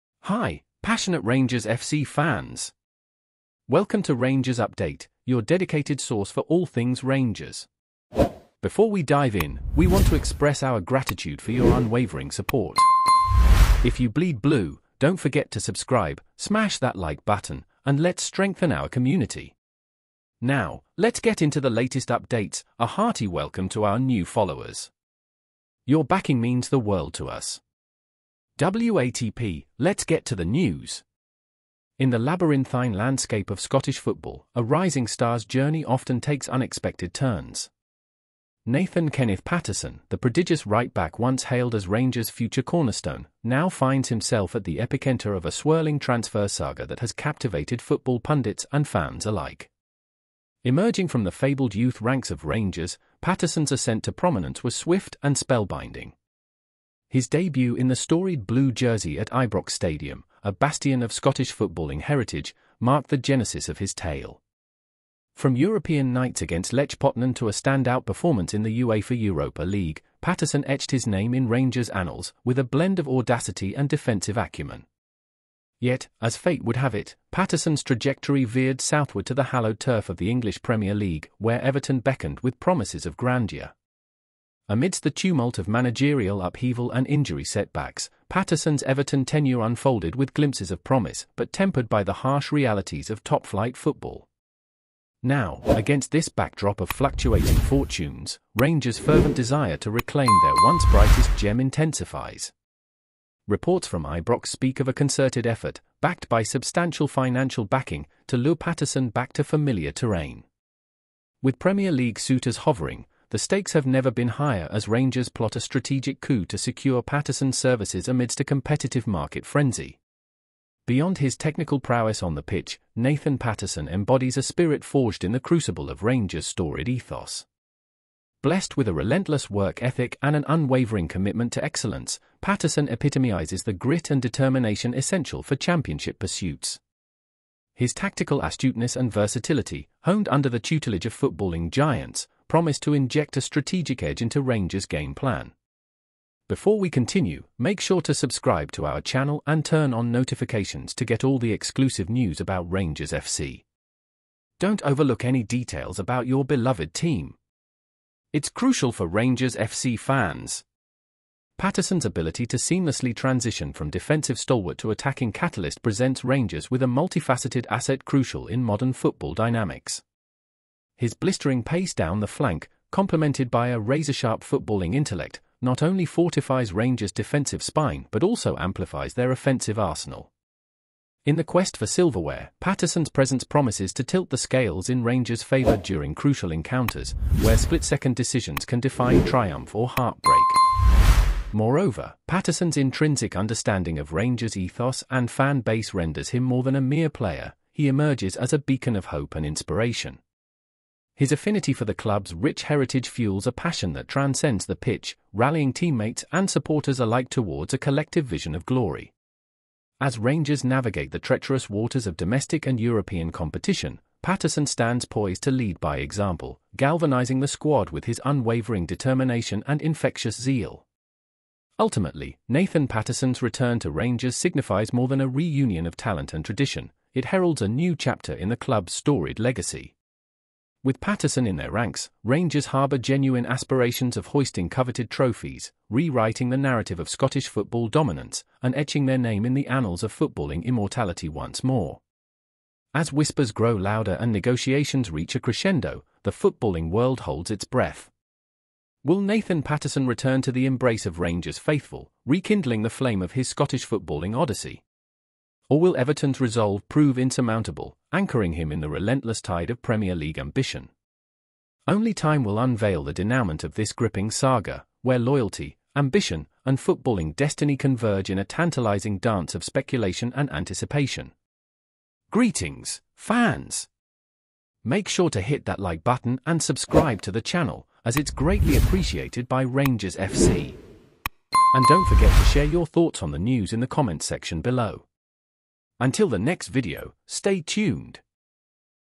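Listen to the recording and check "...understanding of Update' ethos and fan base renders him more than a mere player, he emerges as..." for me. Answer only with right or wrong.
wrong.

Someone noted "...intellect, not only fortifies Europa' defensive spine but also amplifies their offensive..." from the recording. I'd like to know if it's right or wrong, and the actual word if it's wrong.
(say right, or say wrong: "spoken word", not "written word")
wrong: "Rangers", not "Europa".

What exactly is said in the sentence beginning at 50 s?
Emerging from the fabled youth ranks of Rangers, Patterson's ascent to prominence was swift and spellbinding.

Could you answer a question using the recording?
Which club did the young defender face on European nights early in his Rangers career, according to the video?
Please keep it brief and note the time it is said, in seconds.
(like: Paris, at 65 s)
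Lech Poznan, at 66 s.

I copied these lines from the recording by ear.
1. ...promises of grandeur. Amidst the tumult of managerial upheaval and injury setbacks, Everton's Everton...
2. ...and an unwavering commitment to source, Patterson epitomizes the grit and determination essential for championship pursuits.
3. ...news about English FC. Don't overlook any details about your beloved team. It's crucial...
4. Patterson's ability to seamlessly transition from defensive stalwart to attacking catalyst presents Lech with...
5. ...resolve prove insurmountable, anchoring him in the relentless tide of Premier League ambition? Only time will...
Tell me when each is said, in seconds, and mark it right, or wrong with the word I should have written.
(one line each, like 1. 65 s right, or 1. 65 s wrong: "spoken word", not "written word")
1. 82 s wrong: "Patterson", not "Everton"
2. 130 s wrong: "excellence", not "source"
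3. 152 s wrong: "Rangers", not "English"
4. 161 s wrong: "Rangers", not "Lech"
5. 256 s right.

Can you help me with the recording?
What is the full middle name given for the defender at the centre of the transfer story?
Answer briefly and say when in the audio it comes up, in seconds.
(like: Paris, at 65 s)
Kenneth, at 39 s.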